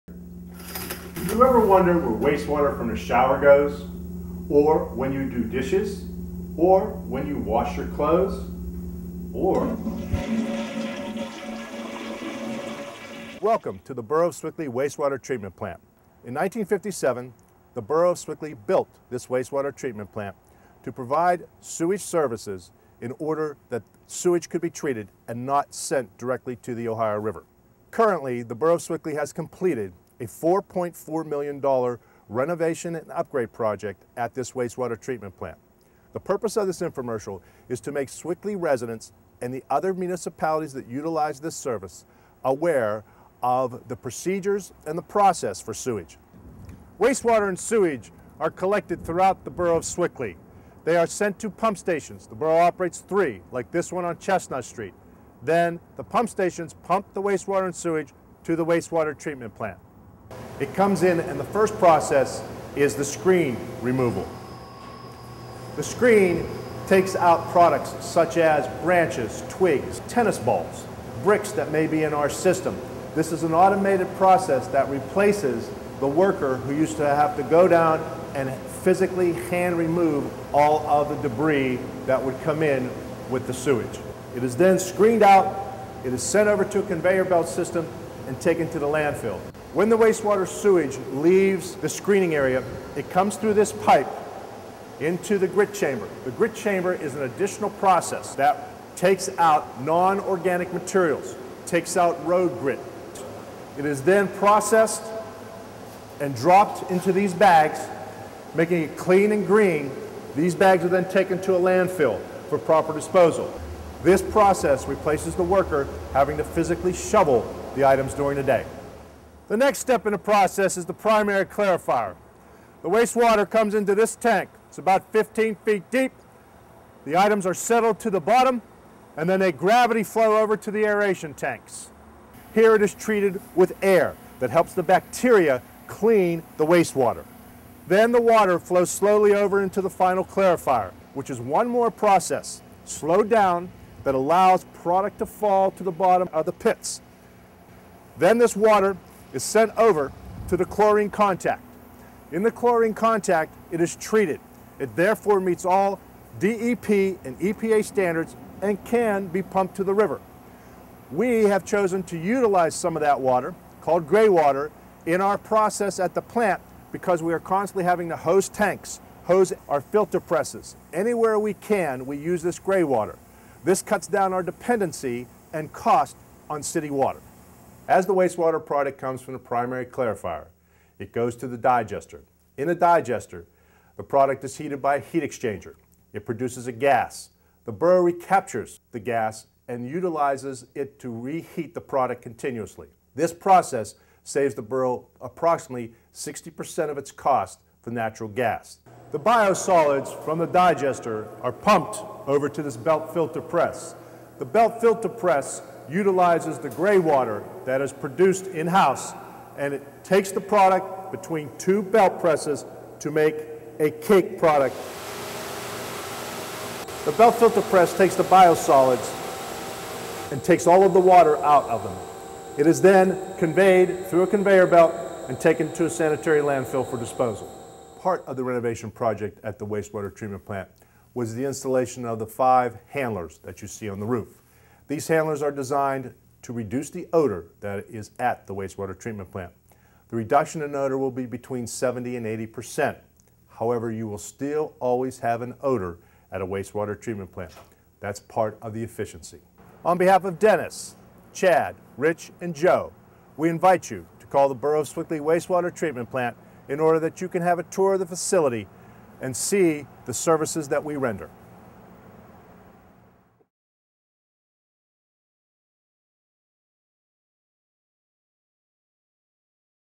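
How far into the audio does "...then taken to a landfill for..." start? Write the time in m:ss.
1:50.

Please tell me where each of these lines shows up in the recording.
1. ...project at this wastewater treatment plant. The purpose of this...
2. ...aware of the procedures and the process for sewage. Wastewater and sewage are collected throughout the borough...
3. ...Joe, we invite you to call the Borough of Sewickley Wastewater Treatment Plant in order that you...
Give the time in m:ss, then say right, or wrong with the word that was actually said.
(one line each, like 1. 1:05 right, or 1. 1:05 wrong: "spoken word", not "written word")
1. 0:33 right
2. 0:42 right
3. 4:12 right.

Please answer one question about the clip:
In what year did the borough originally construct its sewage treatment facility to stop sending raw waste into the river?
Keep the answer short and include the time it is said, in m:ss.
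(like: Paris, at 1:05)
1957, at 0:16.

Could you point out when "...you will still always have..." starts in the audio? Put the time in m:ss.
4:03.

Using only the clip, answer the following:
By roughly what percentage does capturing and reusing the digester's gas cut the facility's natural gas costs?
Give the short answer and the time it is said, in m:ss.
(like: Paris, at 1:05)
60%, at 3:16.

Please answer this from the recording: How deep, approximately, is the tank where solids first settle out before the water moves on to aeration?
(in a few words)
15 feet.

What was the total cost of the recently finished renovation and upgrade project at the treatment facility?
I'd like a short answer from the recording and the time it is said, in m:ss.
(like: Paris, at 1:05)
$4.4 million, at 0:30.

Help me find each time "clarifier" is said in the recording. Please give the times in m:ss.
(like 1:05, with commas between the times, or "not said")
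2:01, 2:20, 2:59.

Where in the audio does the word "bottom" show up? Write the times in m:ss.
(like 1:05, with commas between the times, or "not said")
2:08, 2:25.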